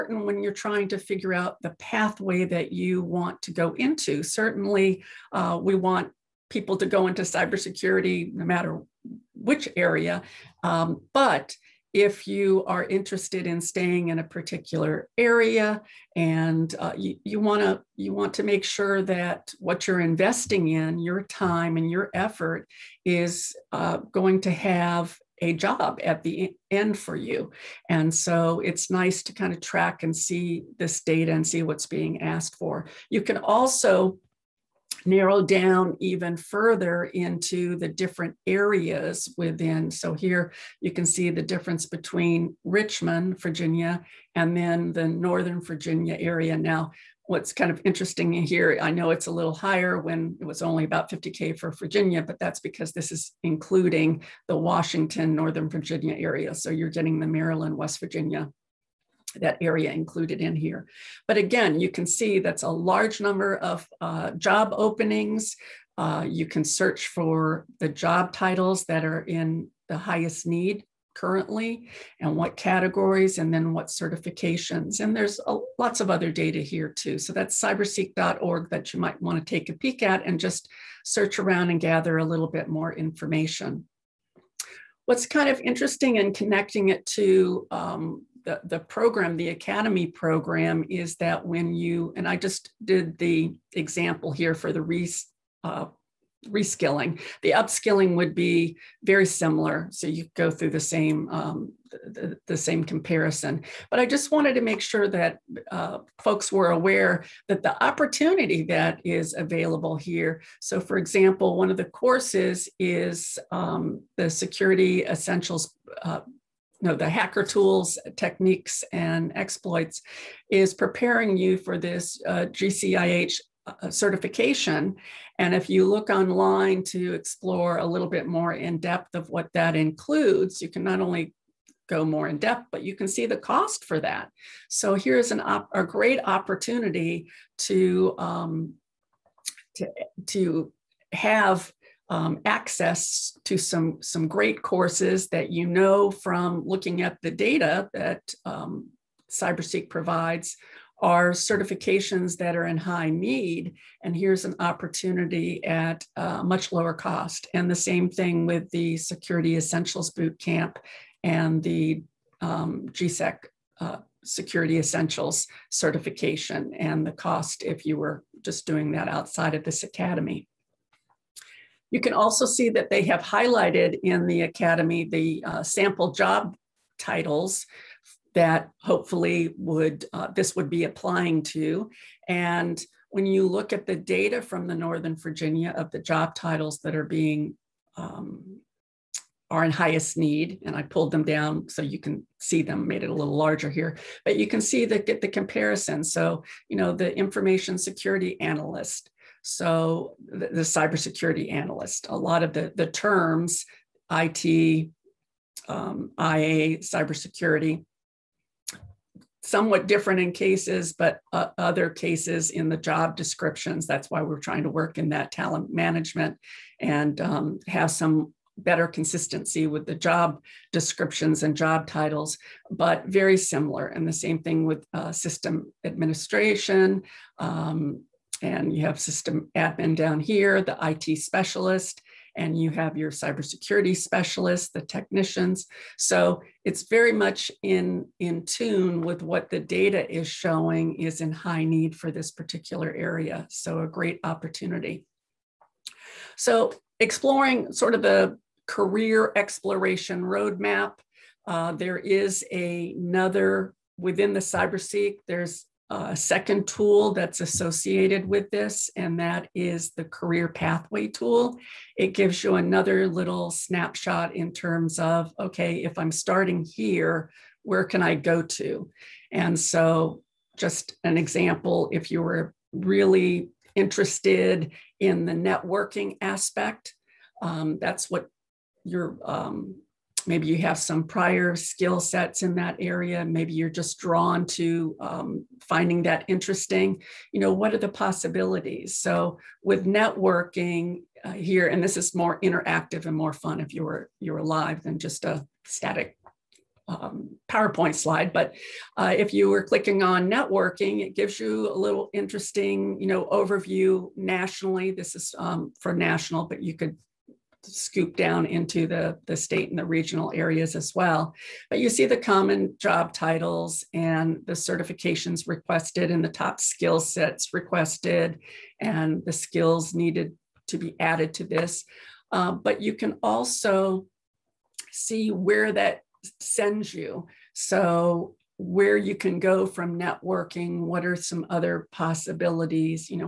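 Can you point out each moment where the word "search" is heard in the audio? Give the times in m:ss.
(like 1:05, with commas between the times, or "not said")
1:06, 1:21.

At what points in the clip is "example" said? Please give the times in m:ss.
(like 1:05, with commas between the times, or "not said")
1:33, 1:50, 4:31.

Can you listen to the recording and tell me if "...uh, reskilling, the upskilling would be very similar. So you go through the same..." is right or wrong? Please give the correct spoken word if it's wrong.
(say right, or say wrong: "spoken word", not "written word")
right.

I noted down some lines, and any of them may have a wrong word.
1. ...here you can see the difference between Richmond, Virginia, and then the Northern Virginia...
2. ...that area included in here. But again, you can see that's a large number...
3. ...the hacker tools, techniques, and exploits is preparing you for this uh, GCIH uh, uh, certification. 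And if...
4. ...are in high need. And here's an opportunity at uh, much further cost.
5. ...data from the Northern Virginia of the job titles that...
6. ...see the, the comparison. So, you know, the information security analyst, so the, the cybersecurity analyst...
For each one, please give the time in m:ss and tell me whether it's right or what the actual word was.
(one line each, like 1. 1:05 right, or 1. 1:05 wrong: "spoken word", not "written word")
1. 0:40 right
2. 0:59 right
3. 1:56 right
4. 2:32 wrong: "lower", not "further"
5. 3:03 right
6. 3:14 right.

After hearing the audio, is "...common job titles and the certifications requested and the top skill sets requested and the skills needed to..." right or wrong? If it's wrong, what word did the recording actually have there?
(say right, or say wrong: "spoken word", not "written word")
right.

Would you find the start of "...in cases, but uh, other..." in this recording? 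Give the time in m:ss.
3:30.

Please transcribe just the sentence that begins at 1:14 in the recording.
And there's a, lots of other data here too.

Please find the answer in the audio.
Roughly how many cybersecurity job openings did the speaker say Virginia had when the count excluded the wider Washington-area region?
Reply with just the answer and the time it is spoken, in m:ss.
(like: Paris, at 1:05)
50K, at 0:51.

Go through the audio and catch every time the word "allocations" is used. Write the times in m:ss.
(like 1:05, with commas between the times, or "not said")
not said.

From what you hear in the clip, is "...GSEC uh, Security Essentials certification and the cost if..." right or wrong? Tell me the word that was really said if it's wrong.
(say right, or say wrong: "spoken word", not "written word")
right.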